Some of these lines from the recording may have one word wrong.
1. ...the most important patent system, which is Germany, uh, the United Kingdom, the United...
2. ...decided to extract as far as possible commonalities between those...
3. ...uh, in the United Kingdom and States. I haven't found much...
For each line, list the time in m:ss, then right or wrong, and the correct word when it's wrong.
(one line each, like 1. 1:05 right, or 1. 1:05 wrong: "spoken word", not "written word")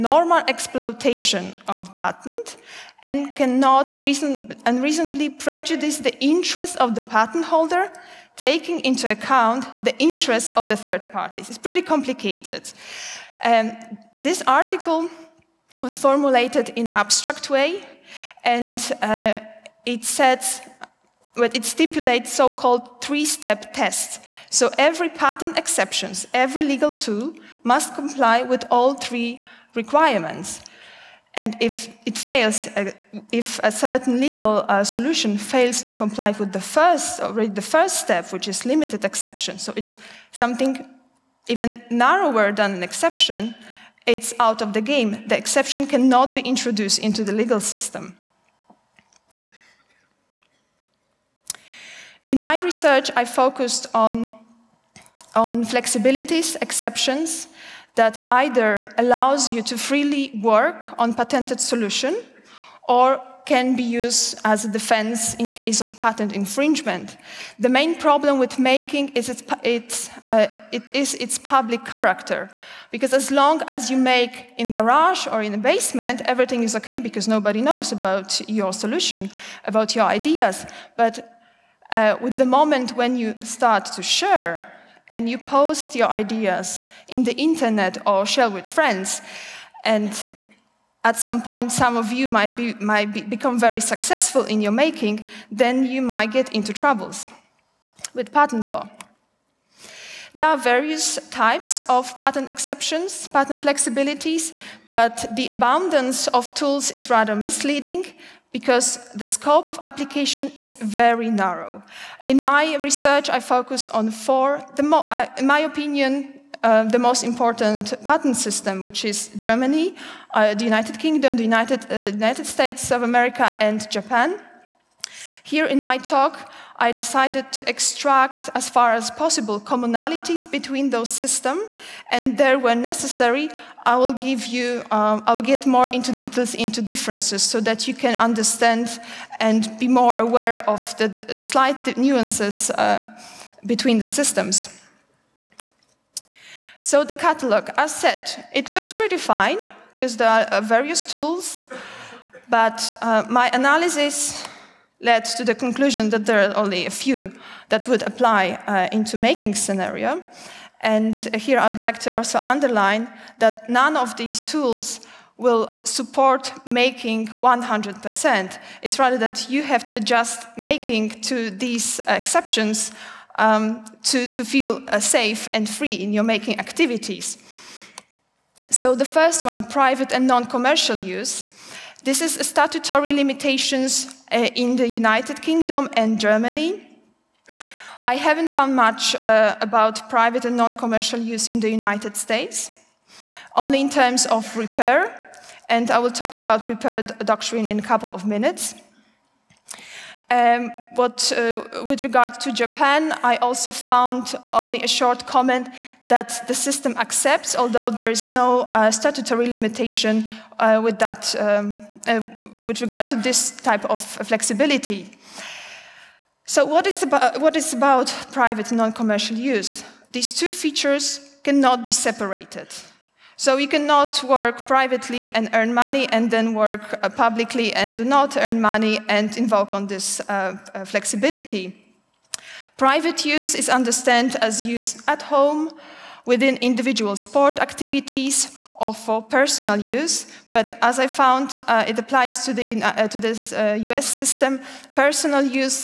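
1. 1:56 right
2. 2:06 right
3. 3:04 wrong: "Germany", not "States".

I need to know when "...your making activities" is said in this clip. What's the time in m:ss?
2:56.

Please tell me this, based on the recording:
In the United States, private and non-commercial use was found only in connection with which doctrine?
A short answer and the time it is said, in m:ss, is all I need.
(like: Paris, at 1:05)
repair doctrine, at 3:16.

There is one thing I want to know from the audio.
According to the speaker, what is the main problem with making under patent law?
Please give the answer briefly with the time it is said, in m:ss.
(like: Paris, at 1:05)
its public character, at 1:11.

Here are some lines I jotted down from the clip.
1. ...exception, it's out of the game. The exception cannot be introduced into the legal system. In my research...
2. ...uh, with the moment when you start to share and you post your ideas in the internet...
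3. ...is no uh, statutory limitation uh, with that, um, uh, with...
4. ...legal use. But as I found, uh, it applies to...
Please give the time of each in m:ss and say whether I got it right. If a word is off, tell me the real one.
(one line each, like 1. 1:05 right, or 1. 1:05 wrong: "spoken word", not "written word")
1. 0:42 right
2. 1:21 right
3. 3:28 right
4. 3:59 wrong: "personal", not "legal".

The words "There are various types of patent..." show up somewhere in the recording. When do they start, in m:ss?
1:40.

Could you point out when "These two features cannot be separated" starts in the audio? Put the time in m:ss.
3:40.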